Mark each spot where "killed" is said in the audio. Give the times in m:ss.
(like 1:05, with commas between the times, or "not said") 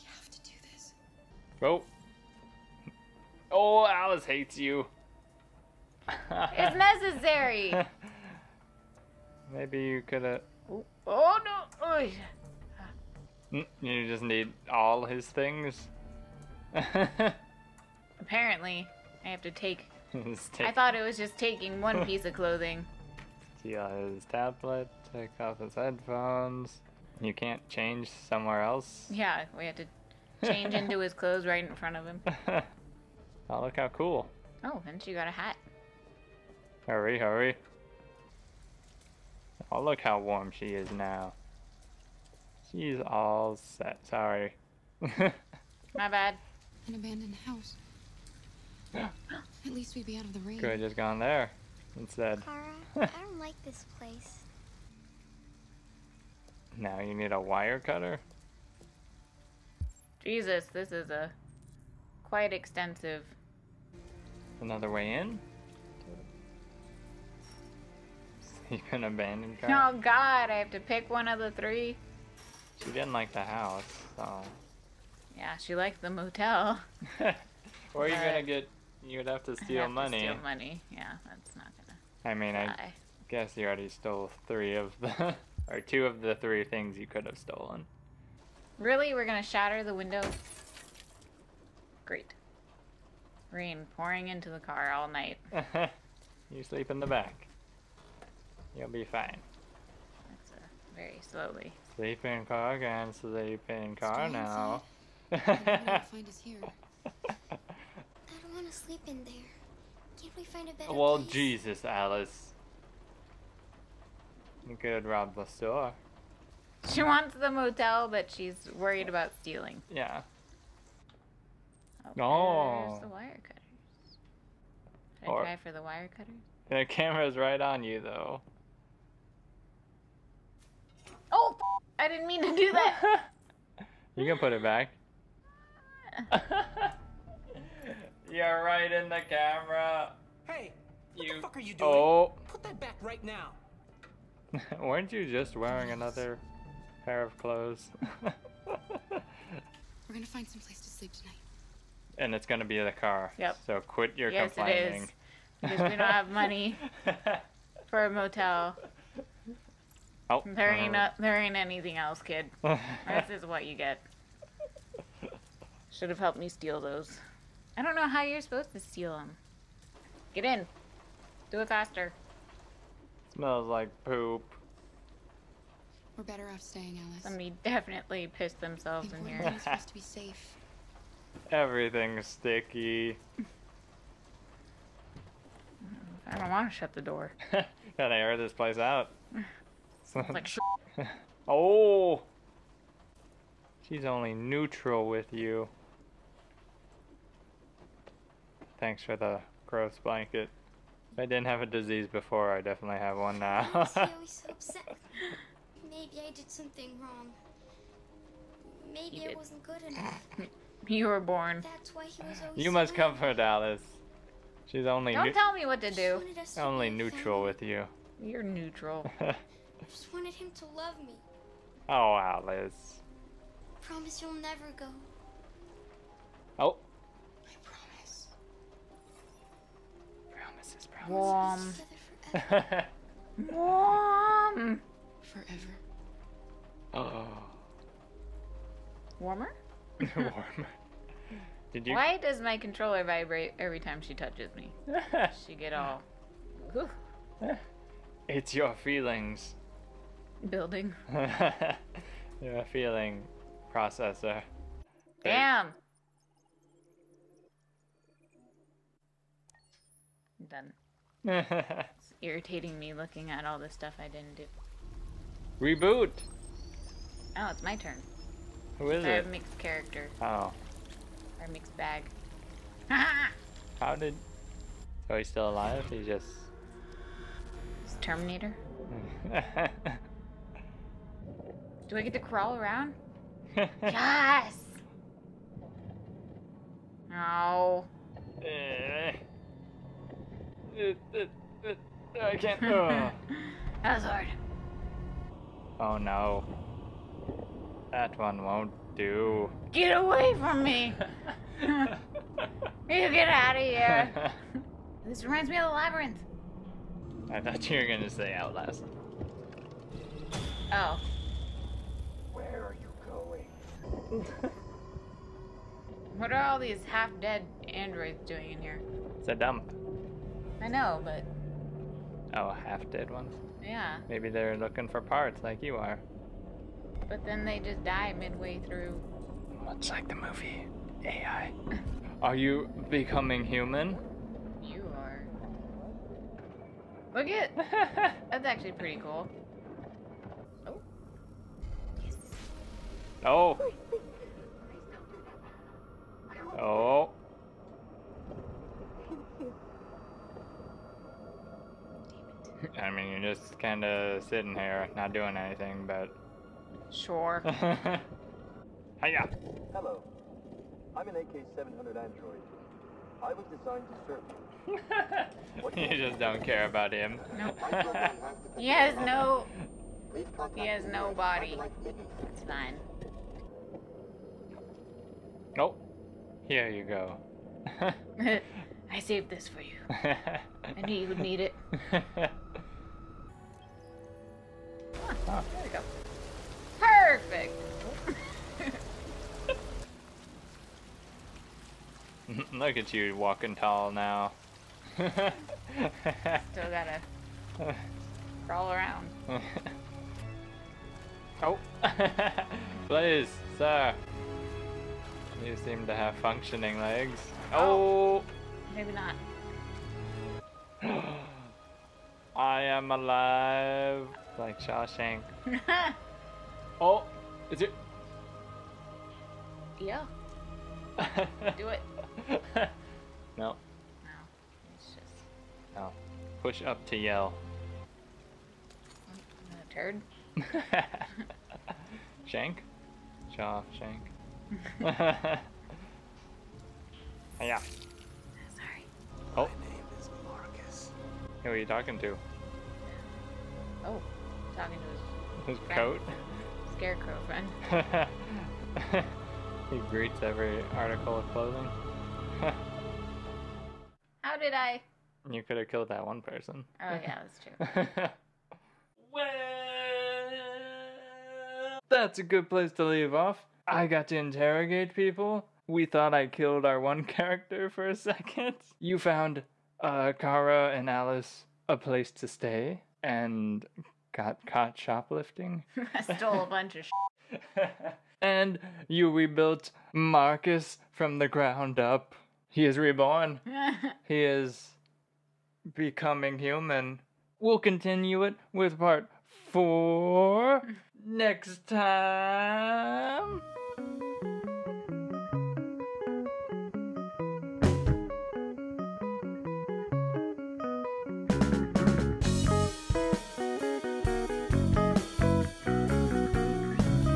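7:35, 7:46.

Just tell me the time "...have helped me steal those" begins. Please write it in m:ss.
2:46.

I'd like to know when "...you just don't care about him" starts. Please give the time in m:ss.
6:05.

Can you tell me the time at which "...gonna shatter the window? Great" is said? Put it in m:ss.
1:29.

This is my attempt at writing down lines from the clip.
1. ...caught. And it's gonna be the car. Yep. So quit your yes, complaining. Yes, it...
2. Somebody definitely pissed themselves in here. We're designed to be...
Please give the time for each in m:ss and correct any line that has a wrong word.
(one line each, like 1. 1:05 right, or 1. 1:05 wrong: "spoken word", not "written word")
1. 2:31 wrong: "tonight", not "caught"
2. 2:57 wrong: "supposed", not "designed".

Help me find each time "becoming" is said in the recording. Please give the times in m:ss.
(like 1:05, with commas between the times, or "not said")
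5:32, 8:05.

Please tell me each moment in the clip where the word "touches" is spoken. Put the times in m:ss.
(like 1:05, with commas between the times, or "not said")
4:04.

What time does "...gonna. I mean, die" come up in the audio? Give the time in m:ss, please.
1:21.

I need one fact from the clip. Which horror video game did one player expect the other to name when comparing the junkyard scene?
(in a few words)
Outlast.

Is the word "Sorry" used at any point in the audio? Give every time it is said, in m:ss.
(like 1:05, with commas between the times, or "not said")
0:44, 7:17.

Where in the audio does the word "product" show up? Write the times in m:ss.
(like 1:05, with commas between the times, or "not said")
not said.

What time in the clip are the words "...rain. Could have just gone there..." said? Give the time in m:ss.
0:50.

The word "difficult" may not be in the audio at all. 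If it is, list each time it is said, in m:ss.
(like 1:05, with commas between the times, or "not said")
not said.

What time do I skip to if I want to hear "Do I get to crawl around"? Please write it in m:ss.
4:41.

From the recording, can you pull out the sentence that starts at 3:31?
That's why he was always You must come for Alice.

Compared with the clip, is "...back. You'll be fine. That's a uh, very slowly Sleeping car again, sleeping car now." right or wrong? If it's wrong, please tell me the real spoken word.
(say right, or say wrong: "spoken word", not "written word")
right.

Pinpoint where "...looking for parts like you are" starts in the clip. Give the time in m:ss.
5:24.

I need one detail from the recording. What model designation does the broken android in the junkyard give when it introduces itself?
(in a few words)
AK-700.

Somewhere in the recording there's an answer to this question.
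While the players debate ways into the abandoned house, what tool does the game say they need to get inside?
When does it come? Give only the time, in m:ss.
0:57.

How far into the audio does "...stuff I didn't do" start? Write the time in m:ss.
4:23.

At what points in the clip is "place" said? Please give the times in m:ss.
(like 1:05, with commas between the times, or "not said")
0:53, 1:51, 2:30, 3:08, 7:42, 7:51.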